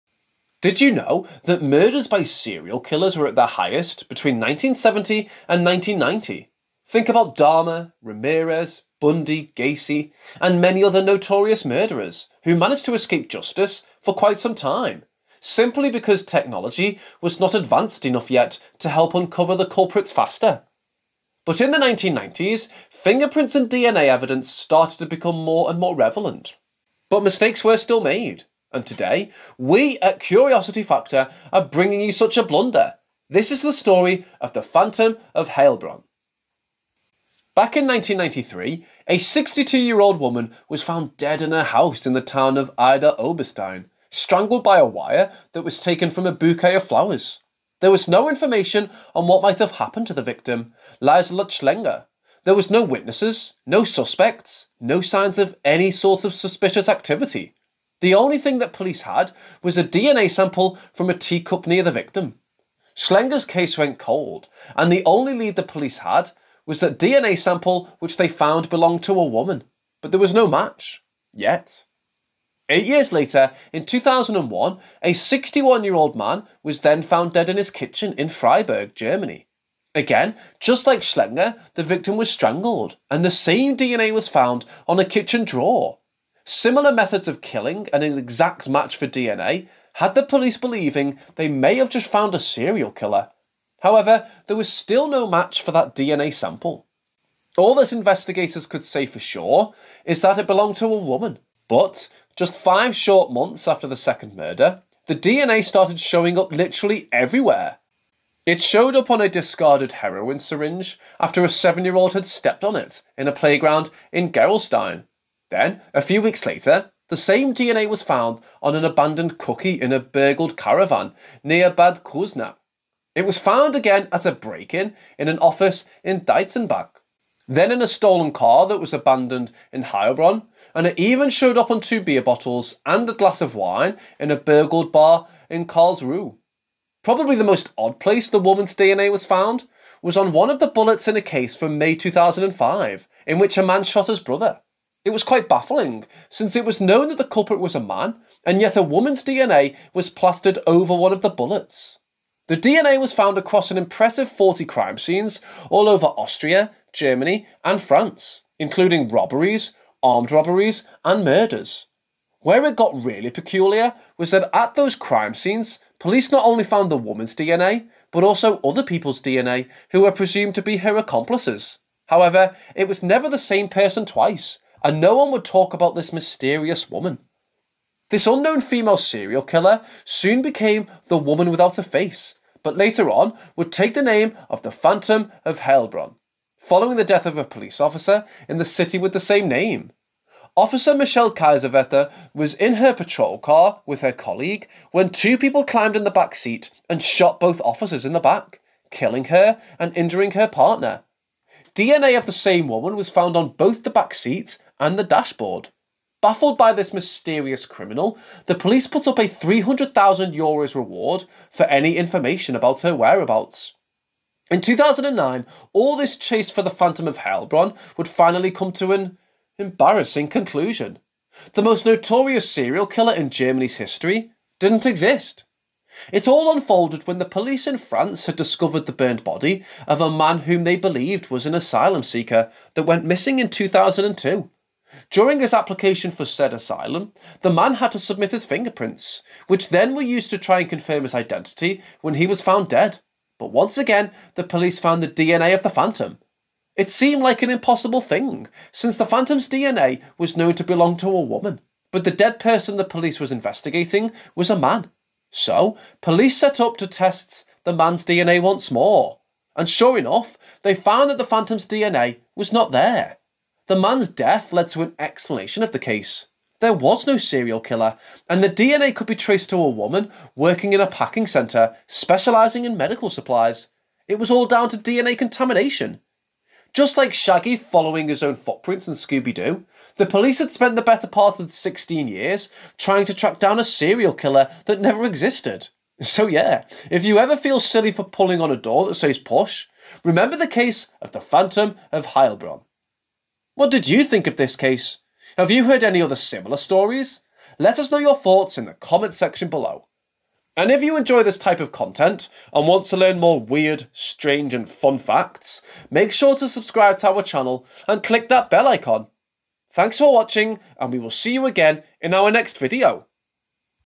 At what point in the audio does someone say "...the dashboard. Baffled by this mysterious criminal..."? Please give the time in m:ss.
3:24.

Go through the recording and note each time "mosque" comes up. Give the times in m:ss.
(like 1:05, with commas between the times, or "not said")
not said.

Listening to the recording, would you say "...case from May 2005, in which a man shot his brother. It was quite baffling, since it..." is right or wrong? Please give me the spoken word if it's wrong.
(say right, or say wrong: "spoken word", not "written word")
right.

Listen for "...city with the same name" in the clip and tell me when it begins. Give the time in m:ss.
3:08.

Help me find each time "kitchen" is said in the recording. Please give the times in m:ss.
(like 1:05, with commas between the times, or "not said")
1:17, 1:25.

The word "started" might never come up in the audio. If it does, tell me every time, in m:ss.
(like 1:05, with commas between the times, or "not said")
0:24, 1:45.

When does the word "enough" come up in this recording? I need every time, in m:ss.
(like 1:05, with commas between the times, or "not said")
0:18, 4:19.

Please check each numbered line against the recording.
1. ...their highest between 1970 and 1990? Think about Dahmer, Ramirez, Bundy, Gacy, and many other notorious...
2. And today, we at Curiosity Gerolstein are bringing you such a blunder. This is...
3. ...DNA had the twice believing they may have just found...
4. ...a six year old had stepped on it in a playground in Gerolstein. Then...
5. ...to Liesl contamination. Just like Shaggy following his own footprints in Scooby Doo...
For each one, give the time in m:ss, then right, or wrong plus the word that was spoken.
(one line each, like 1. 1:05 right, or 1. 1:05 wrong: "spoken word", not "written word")
1. 0:03 right
2. 0:28 wrong: "Factor", not "Gerolstein"
3. 1:29 wrong: "police", not "twice"
4. 1:51 wrong: "seven", not "six"
5. 4:34 wrong: "DNA", not "Liesl".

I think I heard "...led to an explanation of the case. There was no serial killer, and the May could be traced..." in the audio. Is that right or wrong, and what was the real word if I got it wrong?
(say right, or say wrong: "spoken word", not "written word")
wrong: "DNA", not "May".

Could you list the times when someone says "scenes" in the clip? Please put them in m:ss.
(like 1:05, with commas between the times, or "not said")
2:34, 2:45.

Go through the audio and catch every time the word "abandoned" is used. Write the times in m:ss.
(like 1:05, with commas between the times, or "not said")
1:58, 2:08.